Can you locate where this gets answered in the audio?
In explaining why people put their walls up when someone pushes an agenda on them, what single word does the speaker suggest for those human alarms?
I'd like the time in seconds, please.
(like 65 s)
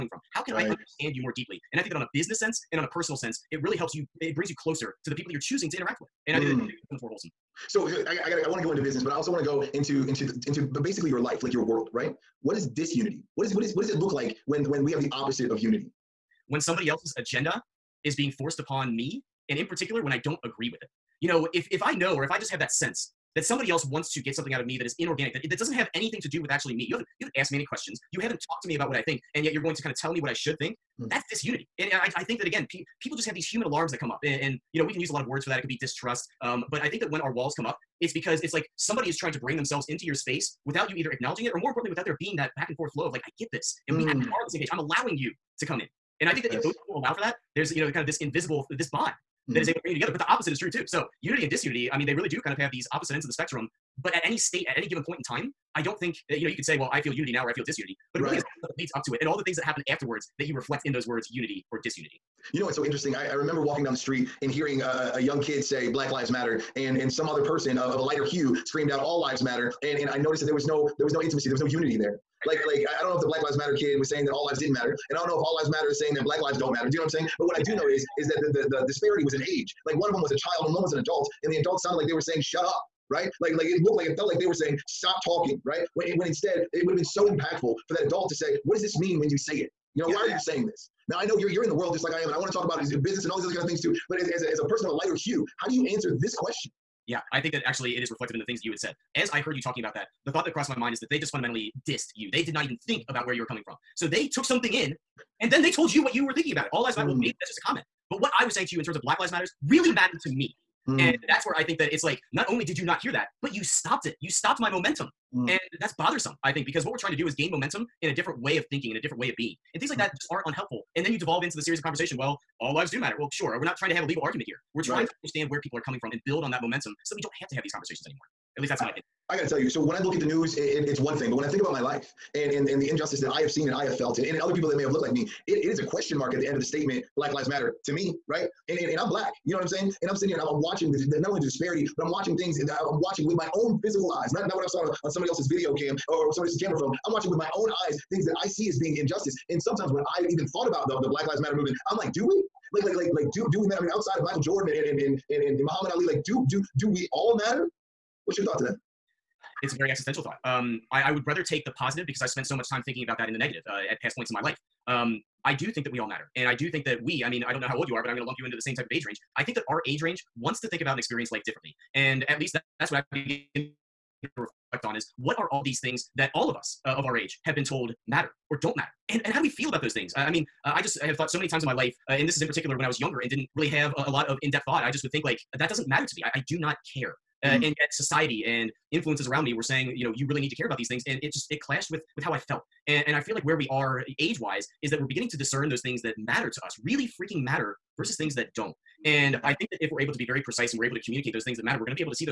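35 s.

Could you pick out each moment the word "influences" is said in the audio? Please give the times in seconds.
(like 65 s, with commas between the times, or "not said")
188 s.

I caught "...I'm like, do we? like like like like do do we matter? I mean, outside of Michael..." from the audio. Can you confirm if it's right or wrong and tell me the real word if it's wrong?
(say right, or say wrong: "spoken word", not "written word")
right.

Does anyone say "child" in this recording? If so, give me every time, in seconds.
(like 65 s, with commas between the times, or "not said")
80 s.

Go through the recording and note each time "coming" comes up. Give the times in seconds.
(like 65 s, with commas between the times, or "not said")
103 s, 125 s.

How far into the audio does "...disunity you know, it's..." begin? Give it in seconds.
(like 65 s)
61 s.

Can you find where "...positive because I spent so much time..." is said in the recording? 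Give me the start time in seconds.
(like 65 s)
161 s.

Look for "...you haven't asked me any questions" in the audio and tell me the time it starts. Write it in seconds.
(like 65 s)
27 s.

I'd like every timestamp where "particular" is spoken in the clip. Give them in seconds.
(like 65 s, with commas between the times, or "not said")
19 s, 182 s.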